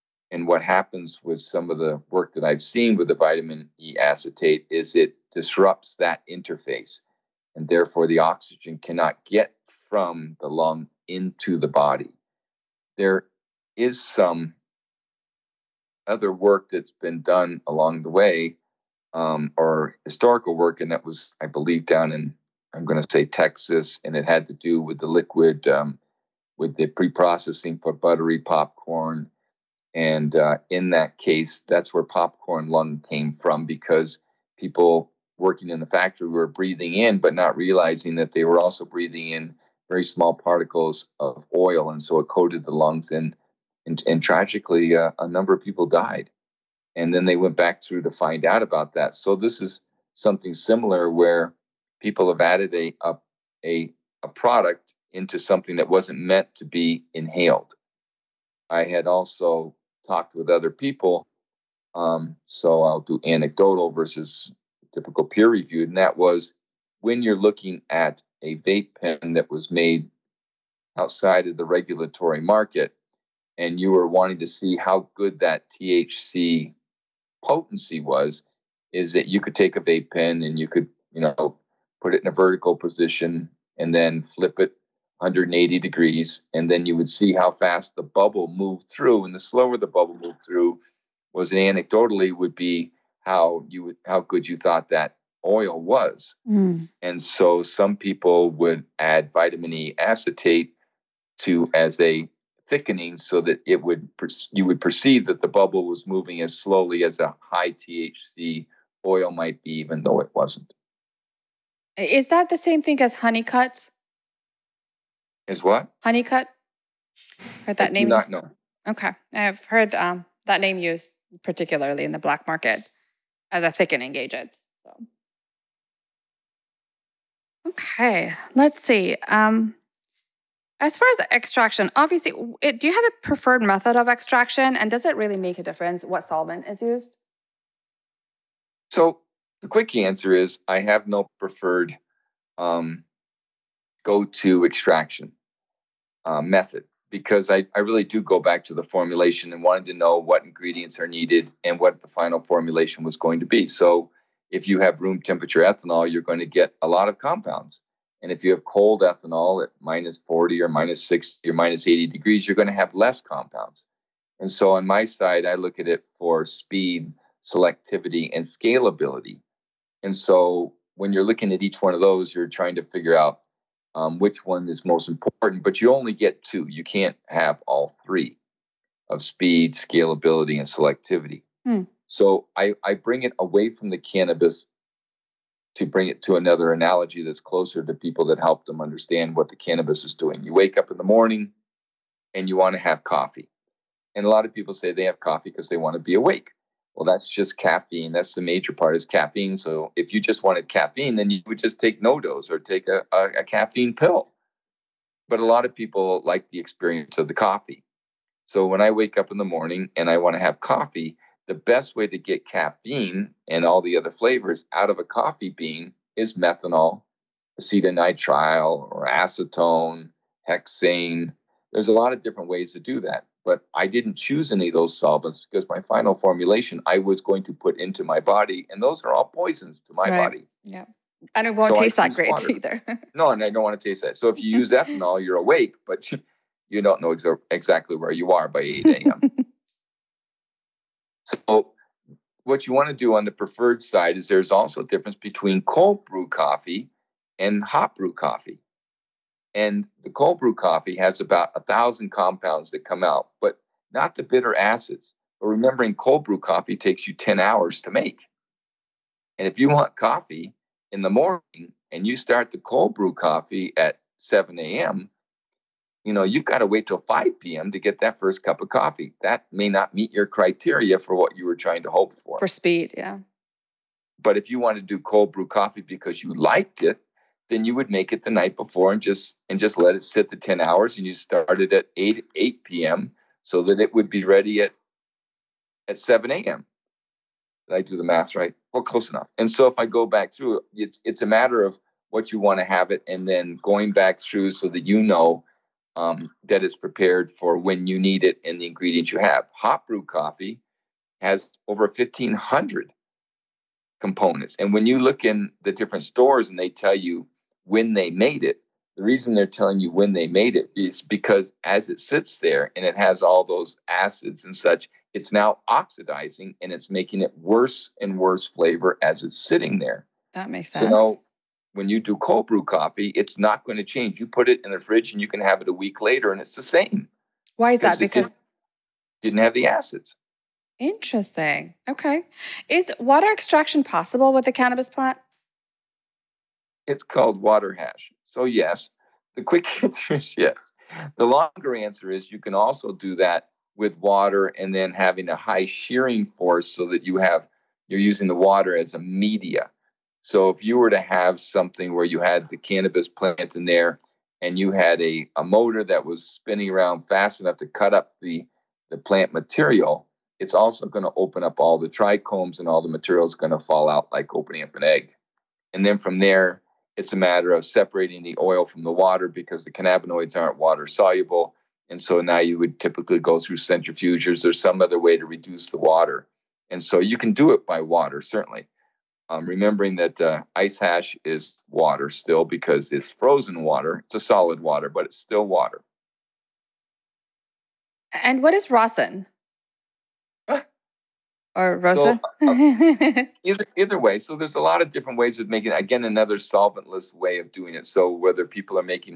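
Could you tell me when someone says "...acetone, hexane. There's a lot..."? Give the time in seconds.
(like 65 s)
219 s.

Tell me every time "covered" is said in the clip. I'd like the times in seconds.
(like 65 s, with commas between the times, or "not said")
not said.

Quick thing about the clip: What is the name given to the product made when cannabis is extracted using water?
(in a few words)
Water hash.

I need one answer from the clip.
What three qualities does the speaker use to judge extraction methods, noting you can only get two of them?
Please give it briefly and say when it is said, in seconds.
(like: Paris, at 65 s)
Speed, selectivity, and scalability, at 166 s.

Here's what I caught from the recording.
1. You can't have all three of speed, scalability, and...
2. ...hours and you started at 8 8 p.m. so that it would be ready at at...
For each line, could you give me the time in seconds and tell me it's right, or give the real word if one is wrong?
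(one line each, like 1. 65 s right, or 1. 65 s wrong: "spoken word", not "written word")
1. 176 s right
2. 280 s right.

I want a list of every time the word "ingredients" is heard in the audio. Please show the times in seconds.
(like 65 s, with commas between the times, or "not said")
150 s, 298 s.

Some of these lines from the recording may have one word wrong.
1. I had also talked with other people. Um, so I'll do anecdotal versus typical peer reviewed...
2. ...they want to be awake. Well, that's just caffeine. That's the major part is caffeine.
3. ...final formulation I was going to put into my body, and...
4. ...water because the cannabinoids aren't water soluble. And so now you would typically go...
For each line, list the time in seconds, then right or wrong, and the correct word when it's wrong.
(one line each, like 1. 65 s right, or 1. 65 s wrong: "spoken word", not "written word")
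1. 58 s right
2. 195 s right
3. 225 s right
4. 368 s right.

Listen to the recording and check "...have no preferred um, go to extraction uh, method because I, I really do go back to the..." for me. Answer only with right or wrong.
right.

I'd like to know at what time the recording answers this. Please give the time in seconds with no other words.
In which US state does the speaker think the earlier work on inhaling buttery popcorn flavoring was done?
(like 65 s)
23 s.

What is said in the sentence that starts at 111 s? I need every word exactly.
Is that the same thing as honeycut?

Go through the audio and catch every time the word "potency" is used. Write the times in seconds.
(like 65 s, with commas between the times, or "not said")
77 s.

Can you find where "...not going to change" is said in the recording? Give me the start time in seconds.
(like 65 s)
323 s.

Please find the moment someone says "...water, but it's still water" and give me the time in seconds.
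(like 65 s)
384 s.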